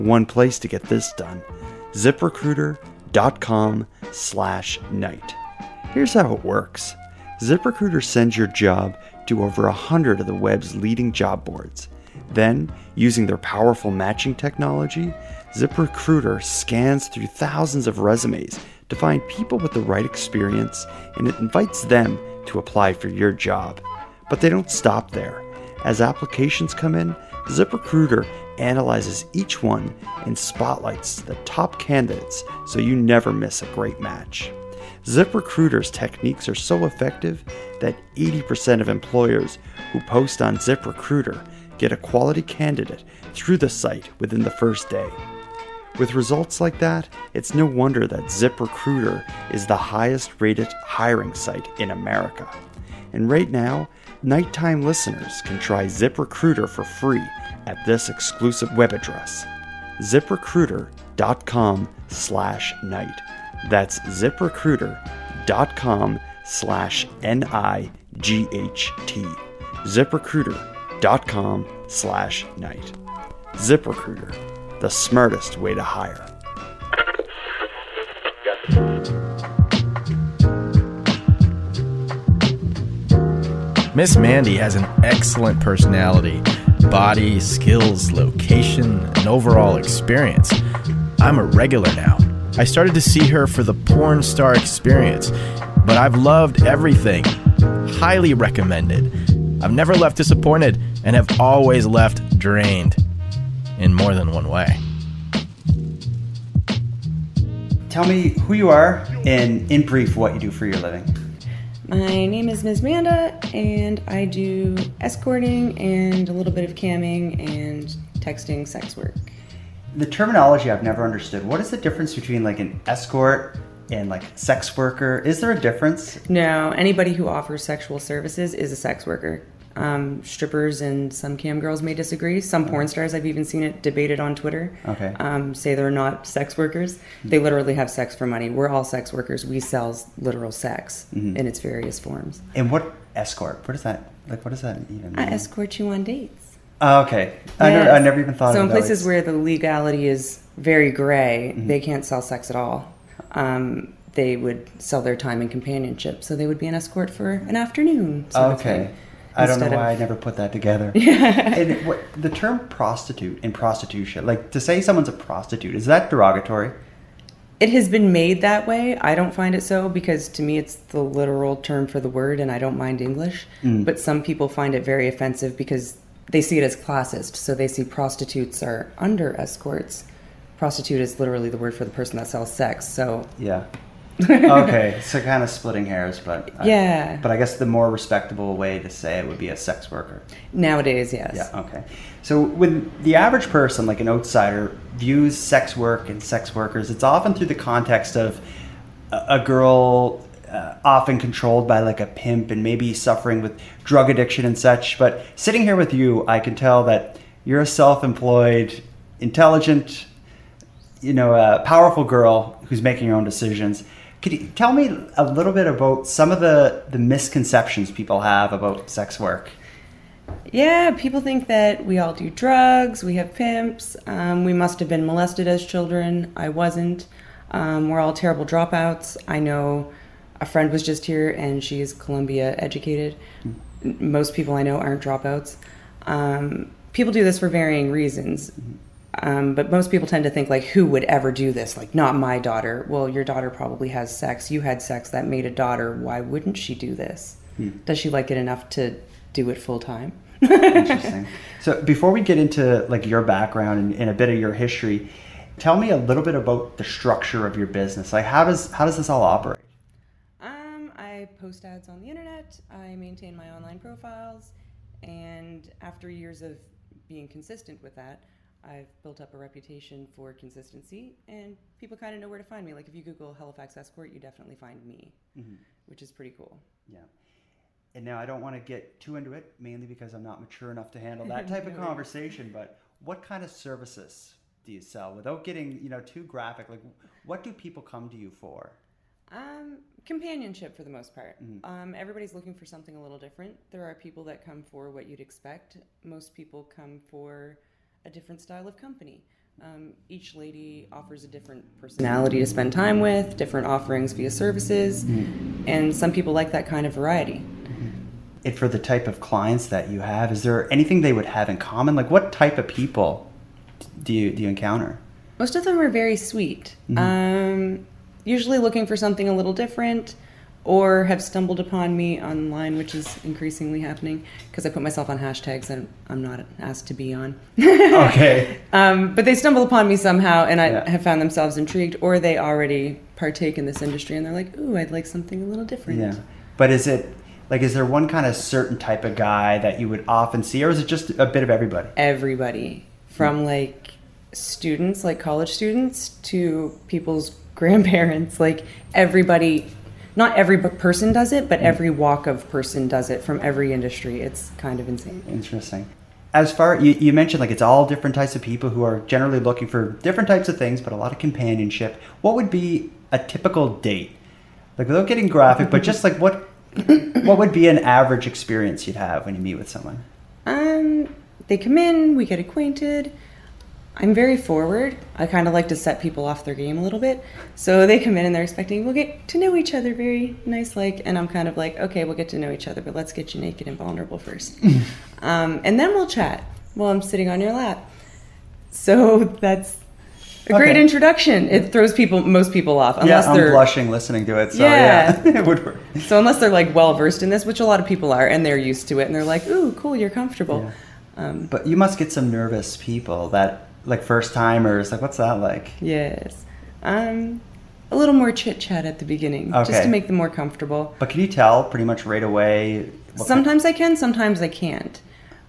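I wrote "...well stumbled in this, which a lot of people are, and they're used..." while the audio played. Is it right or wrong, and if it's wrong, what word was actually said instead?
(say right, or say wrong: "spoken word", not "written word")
wrong: "versed", not "stumbled".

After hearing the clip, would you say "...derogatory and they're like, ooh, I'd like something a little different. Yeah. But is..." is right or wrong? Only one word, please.
wrong.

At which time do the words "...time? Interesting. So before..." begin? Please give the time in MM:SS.
04:09.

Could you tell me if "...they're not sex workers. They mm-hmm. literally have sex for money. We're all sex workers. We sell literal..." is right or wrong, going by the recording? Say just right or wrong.
right.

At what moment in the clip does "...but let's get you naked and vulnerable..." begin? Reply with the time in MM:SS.
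06:22.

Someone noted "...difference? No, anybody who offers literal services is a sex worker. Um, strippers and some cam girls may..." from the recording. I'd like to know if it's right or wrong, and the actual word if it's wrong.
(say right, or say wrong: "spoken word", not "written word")
wrong: "sexual", not "literal".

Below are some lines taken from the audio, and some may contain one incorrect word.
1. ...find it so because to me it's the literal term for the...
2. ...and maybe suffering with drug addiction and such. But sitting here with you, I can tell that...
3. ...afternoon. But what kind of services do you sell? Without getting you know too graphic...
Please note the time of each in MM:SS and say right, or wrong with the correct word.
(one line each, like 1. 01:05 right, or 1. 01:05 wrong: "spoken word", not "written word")
1. 02:49 right
2. 03:22 right
3. 04:41 wrong: "conversation", not "afternoon".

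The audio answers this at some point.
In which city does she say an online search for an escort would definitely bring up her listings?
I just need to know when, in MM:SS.
04:33.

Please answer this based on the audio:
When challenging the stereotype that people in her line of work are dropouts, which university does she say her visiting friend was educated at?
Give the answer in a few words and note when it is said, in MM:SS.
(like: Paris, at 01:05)
Columbia, at 03:51.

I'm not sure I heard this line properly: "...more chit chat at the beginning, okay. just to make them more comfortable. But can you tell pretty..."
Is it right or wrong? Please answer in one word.
right.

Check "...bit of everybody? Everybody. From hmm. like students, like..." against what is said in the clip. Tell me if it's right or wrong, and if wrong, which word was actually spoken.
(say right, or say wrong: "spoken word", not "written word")
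right.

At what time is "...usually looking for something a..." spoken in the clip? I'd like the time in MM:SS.
05:18.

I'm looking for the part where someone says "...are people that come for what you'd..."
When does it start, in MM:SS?
04:53.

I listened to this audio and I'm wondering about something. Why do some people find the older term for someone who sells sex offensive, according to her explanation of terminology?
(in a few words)
classist.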